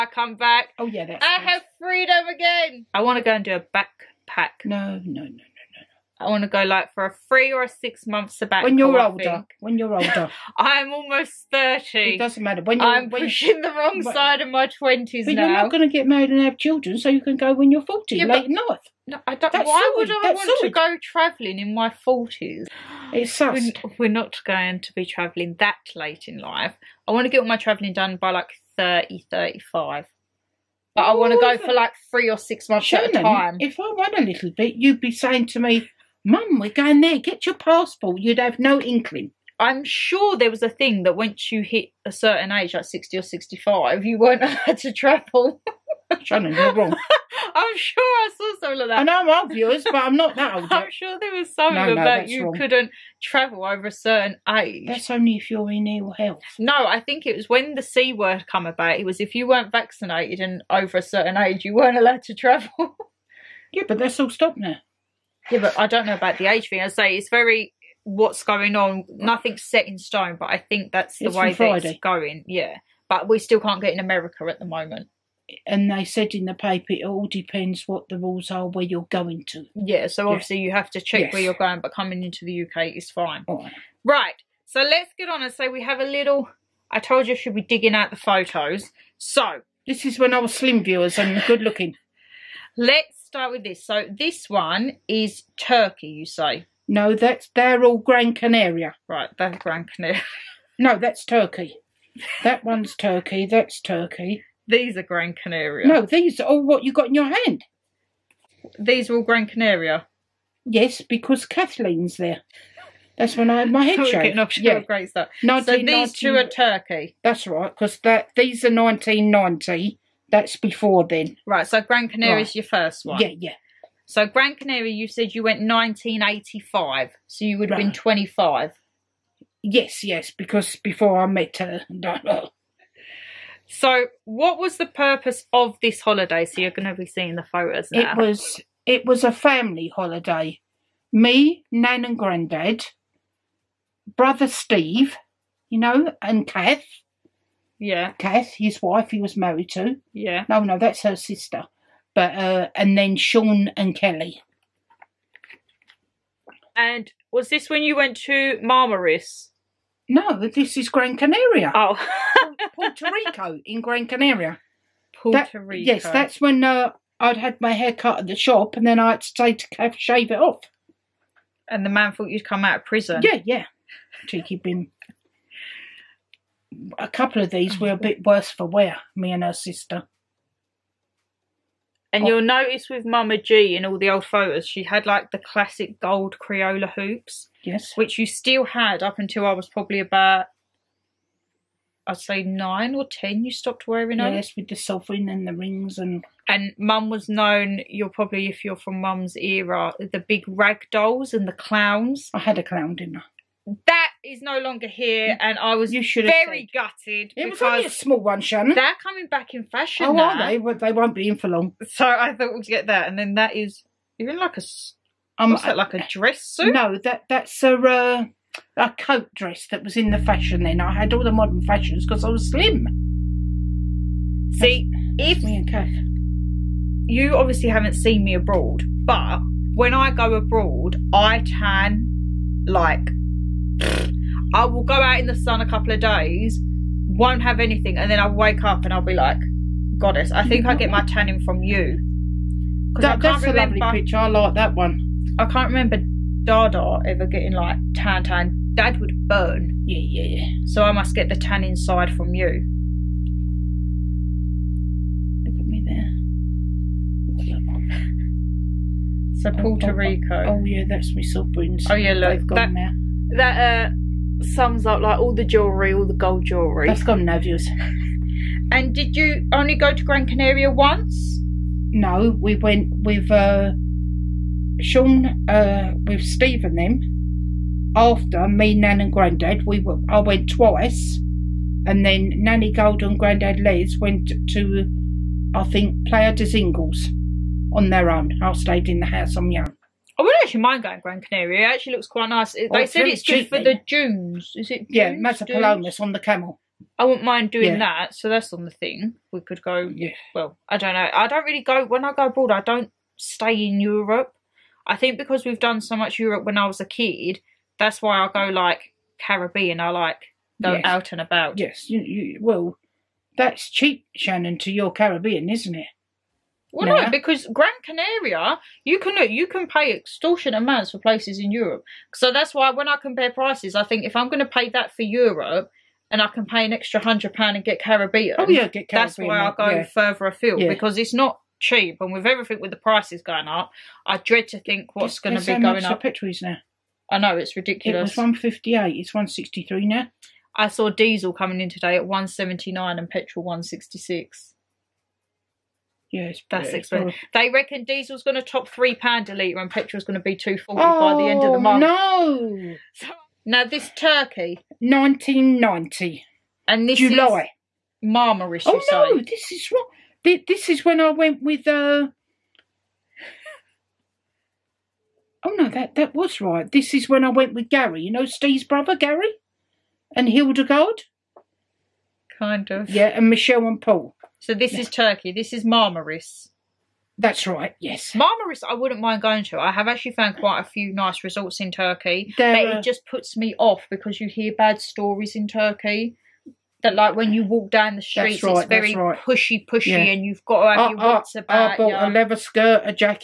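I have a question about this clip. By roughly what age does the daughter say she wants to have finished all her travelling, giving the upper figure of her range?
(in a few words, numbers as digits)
35.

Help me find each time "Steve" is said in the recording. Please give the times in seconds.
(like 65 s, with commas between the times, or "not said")
144 s, 276 s, 368 s.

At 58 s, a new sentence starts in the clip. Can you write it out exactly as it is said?
It was if you weren't vaccinated and over a certain age, you weren't allowed to travel.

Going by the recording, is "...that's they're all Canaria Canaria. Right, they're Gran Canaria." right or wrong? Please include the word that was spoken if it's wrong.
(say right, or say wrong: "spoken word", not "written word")
wrong: "Gran", not "Canaria".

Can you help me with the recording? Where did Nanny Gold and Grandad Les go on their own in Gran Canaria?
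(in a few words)
Playa del Inglés.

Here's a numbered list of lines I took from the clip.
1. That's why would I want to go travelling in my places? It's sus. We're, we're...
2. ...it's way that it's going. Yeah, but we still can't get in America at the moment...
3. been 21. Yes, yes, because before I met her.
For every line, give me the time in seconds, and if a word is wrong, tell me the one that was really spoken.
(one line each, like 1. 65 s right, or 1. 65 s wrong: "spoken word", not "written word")
1. 19 s wrong: "forties", not "places"
2. 71 s right
3. 127 s wrong: "25", not "21".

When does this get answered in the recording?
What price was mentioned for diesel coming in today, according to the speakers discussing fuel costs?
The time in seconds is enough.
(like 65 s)
342 s.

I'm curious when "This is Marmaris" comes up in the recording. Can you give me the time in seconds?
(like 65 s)
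375 s.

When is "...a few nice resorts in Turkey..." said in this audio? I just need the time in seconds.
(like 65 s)
380 s.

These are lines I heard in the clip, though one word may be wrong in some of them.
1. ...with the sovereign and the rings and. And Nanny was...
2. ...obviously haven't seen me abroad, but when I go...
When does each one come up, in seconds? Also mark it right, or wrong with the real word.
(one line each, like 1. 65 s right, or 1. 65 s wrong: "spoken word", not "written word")
1. 194 s wrong: "Mum", not "Nanny"
2. 227 s right.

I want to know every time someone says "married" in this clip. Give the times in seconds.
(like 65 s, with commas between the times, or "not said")
16 s, 149 s.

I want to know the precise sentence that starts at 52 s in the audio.
couldn't travel over a certain age.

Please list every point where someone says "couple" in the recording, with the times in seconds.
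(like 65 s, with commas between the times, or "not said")
177 s, 235 s.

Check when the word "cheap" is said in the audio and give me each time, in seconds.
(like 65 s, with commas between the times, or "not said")
313 s, 331 s.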